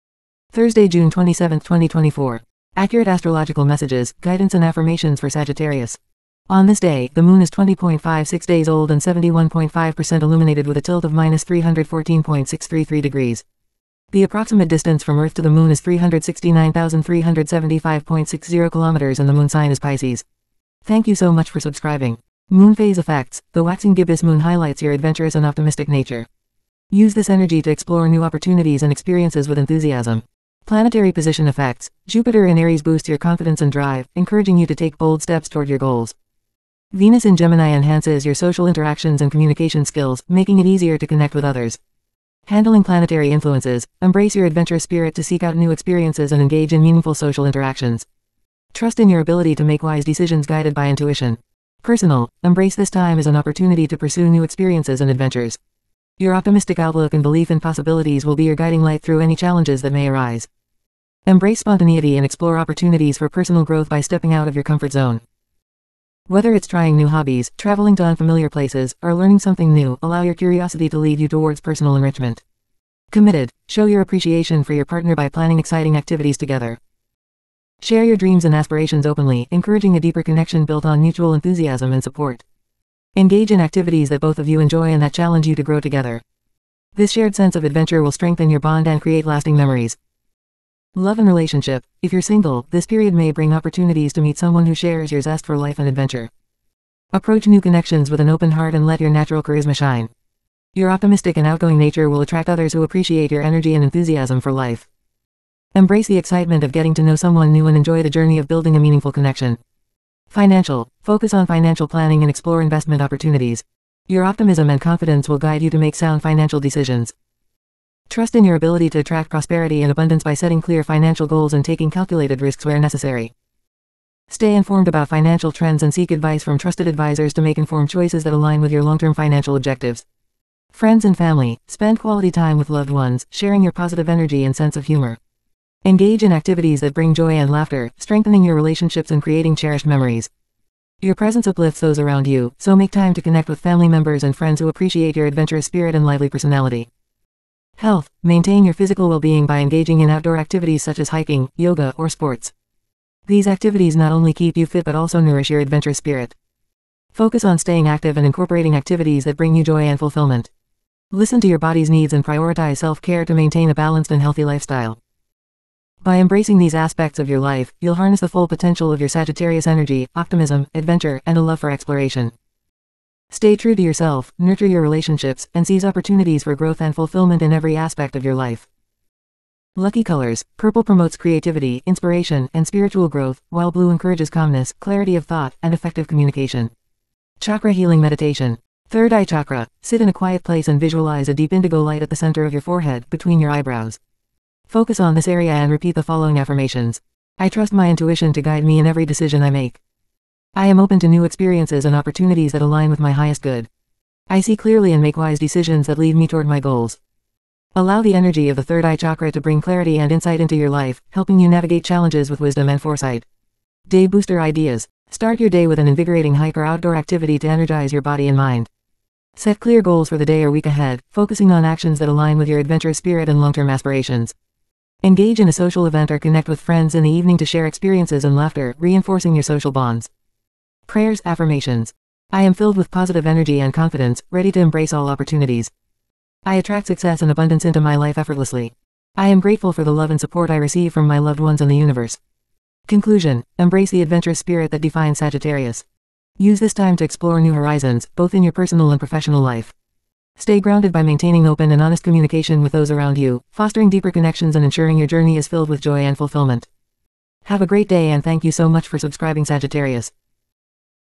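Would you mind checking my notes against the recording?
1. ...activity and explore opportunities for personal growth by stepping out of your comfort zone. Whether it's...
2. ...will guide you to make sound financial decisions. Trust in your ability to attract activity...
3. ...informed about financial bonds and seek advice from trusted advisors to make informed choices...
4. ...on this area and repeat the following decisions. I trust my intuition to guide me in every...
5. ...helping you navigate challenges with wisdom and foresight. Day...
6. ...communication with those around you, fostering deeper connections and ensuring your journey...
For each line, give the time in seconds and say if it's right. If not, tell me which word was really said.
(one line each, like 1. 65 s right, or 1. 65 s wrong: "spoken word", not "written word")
1. 61 s wrong: "spontaneity", not "activity"
2. 115 s wrong: "prosperity", not "activity"
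3. 124 s wrong: "trends", not "bonds"
4. 195 s wrong: "affirmations", not "decisions"
5. 211 s right
6. 252 s right.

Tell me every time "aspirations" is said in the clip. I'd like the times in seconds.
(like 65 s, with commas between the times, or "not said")
78 s, 223 s.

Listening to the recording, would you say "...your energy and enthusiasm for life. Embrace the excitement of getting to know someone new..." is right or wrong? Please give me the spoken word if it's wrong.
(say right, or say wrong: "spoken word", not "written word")
right.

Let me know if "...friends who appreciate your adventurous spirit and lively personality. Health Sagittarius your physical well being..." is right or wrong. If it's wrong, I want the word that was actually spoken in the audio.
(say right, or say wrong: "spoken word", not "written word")
wrong: "Maintain", not "Sagittarius".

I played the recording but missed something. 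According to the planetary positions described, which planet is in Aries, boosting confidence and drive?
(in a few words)
Jupiter.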